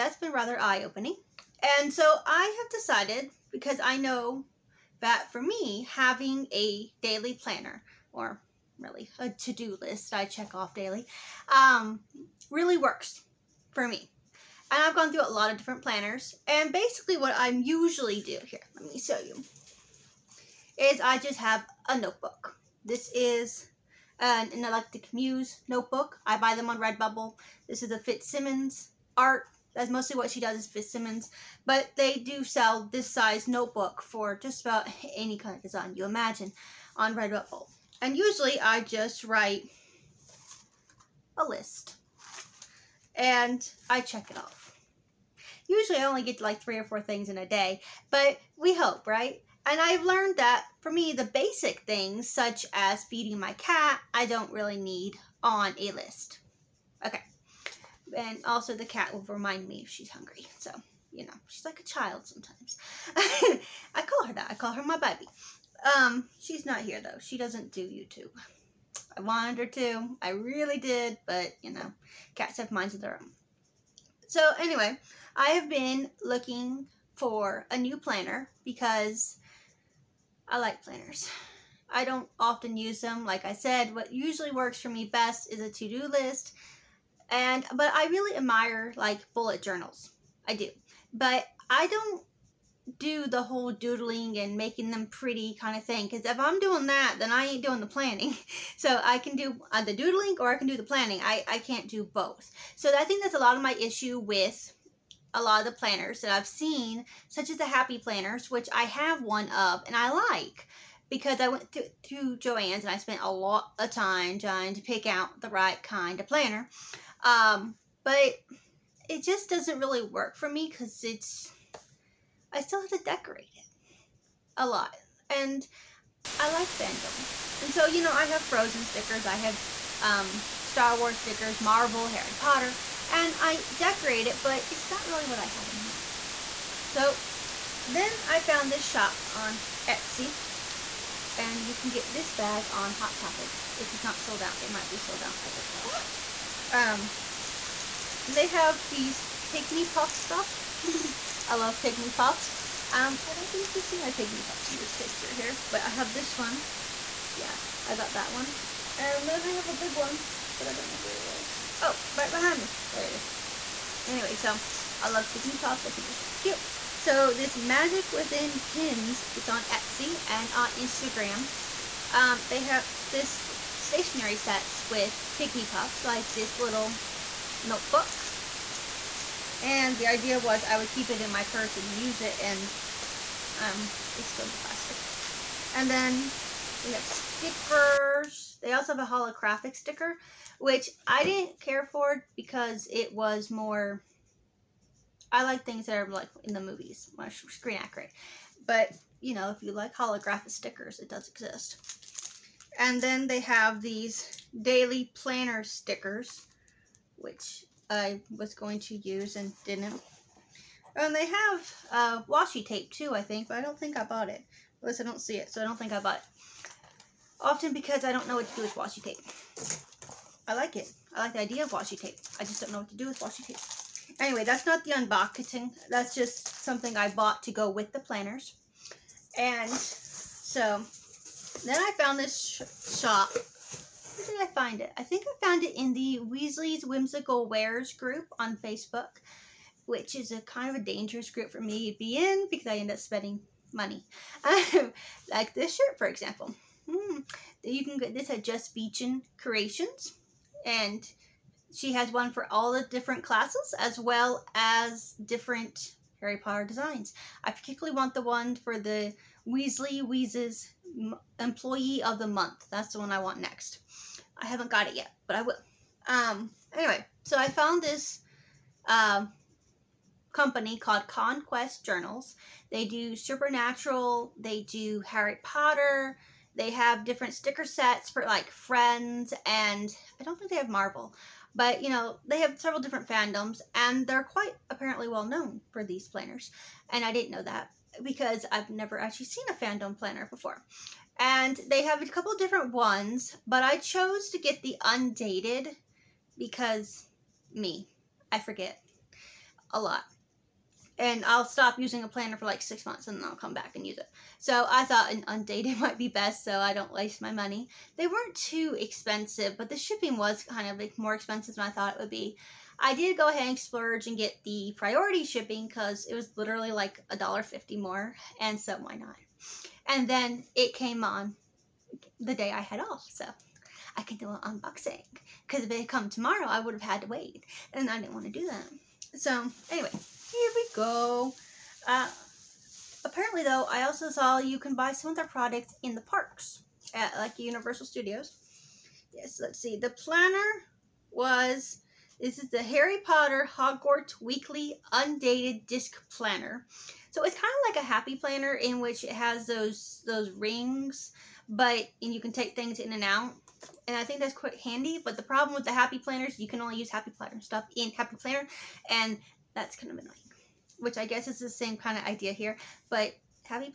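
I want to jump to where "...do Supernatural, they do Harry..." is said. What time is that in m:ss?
4:32.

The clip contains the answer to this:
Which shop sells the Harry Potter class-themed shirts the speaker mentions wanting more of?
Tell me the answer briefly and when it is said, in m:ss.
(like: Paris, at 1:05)
Just Beechin Creations, at 4:08.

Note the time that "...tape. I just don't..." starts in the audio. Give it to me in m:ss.
3:41.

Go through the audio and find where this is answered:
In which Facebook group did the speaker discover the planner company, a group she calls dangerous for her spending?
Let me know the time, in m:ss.
3:56.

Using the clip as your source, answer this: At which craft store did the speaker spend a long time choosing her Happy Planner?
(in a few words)
Joann's.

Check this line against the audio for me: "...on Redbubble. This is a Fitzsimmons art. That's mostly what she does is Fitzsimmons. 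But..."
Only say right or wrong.
right.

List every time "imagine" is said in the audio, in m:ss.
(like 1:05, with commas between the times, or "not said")
0:36.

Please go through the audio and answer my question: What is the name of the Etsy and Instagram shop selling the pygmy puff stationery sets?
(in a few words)
Magic Within pins.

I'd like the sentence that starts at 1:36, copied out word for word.
Because if I'm doing that, then I ain't doing the planning.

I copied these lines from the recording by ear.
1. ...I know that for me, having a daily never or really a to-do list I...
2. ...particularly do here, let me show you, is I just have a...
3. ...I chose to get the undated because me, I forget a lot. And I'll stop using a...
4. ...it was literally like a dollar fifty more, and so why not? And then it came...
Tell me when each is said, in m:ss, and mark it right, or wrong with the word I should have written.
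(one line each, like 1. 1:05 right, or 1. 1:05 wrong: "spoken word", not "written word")
1. 0:03 wrong: "planner", not "never"
2. 0:17 wrong: "usually", not "particularly"
3. 4:53 right
4. 5:16 right.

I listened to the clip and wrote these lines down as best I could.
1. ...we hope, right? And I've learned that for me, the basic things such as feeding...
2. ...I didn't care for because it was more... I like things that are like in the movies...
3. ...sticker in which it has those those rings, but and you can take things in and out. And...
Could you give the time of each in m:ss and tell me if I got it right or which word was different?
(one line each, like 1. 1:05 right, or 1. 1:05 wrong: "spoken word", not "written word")
1. 0:48 right
2. 3:11 right
3. 5:48 wrong: "planner", not "sticker".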